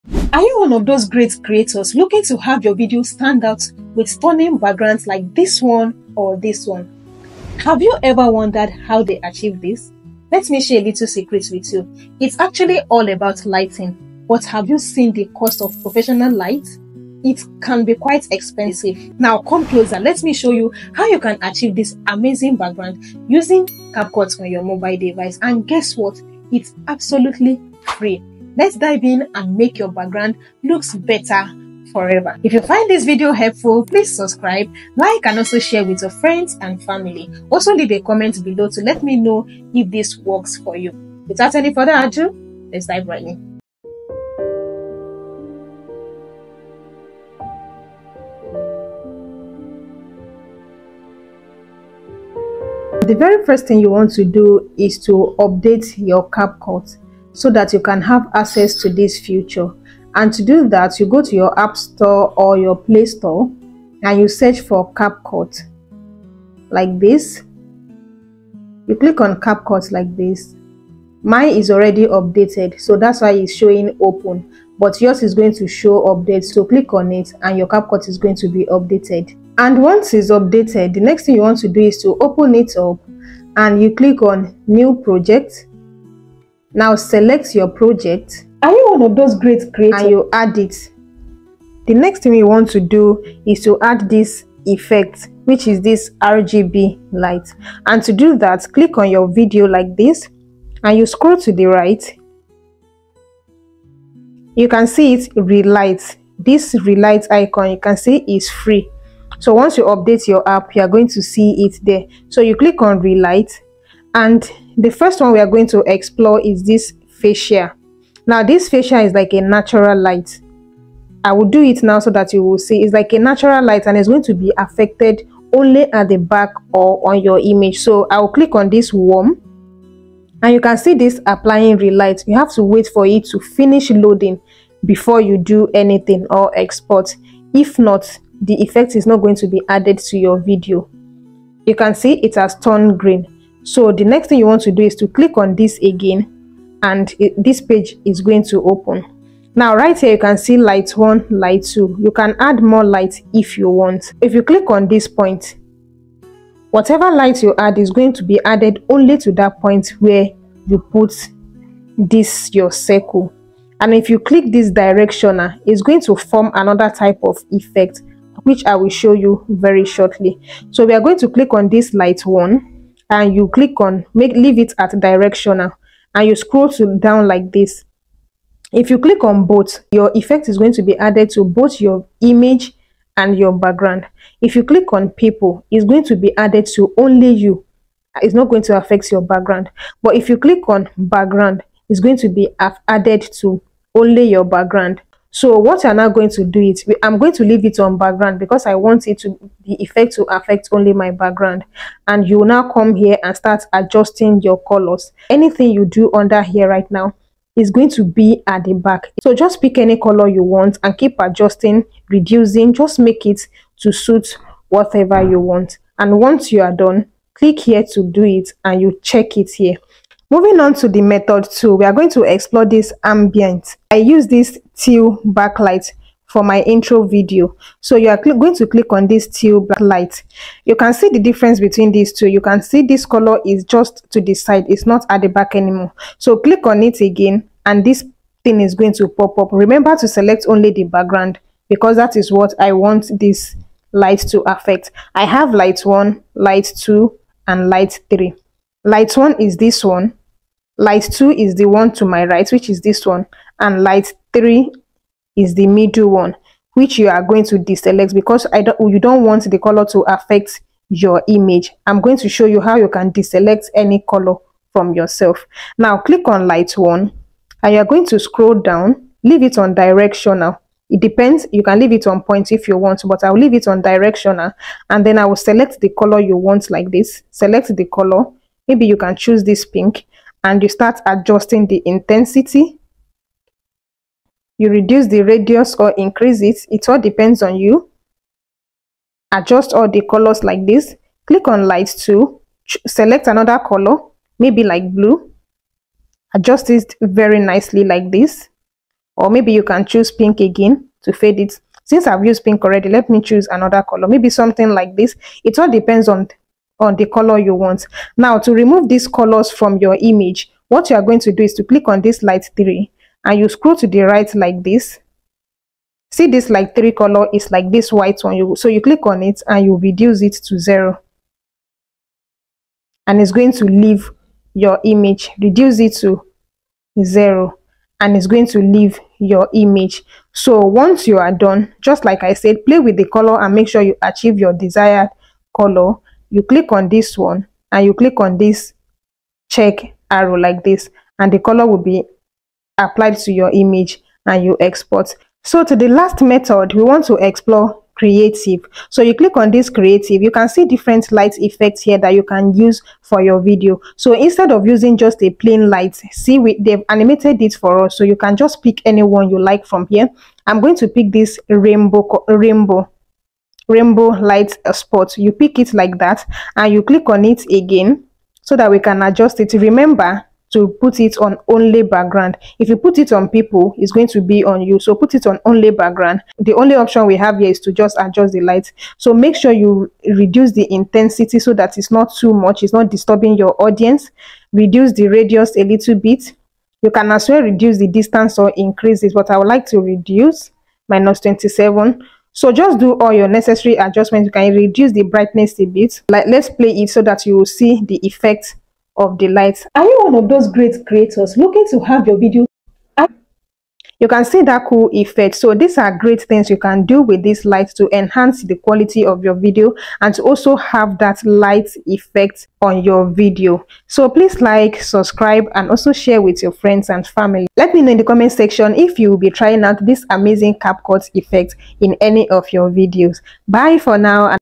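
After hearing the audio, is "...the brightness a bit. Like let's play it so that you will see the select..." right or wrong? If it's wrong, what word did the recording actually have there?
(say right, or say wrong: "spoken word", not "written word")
wrong: "effect", not "select".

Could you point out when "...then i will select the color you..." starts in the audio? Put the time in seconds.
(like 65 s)
275 s.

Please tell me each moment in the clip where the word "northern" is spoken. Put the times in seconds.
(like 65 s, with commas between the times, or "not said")
not said.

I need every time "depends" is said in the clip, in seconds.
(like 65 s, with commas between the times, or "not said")
270 s, 286 s, 305 s.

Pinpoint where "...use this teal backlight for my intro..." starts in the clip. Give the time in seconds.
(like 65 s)
223 s.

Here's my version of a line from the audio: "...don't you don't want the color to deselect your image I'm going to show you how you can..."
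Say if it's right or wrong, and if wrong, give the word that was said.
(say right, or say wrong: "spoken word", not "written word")
wrong: "affect", not "deselect".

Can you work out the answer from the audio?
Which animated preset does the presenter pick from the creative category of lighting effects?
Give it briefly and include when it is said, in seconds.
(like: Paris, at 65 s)
Rainbow light spot, at 363 s.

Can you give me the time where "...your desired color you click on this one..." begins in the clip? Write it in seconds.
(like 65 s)
334 s.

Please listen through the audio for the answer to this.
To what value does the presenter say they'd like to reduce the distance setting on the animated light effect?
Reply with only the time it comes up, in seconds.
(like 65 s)
390 s.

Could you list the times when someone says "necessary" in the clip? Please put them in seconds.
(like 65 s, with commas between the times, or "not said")
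393 s.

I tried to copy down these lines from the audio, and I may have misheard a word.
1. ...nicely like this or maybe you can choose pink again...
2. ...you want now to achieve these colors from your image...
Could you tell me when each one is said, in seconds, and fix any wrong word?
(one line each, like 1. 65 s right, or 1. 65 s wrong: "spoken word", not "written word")
1. 297 s right
2. 307 s wrong: "remove", not "achieve".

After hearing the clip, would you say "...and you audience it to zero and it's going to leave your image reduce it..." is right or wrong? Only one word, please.
wrong.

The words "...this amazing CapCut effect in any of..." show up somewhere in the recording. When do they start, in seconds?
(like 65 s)
419 s.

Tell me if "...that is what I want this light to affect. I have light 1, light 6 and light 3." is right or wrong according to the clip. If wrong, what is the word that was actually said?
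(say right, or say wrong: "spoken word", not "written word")
wrong: "2", not "6".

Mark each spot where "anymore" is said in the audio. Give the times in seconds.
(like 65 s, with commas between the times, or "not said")
235 s.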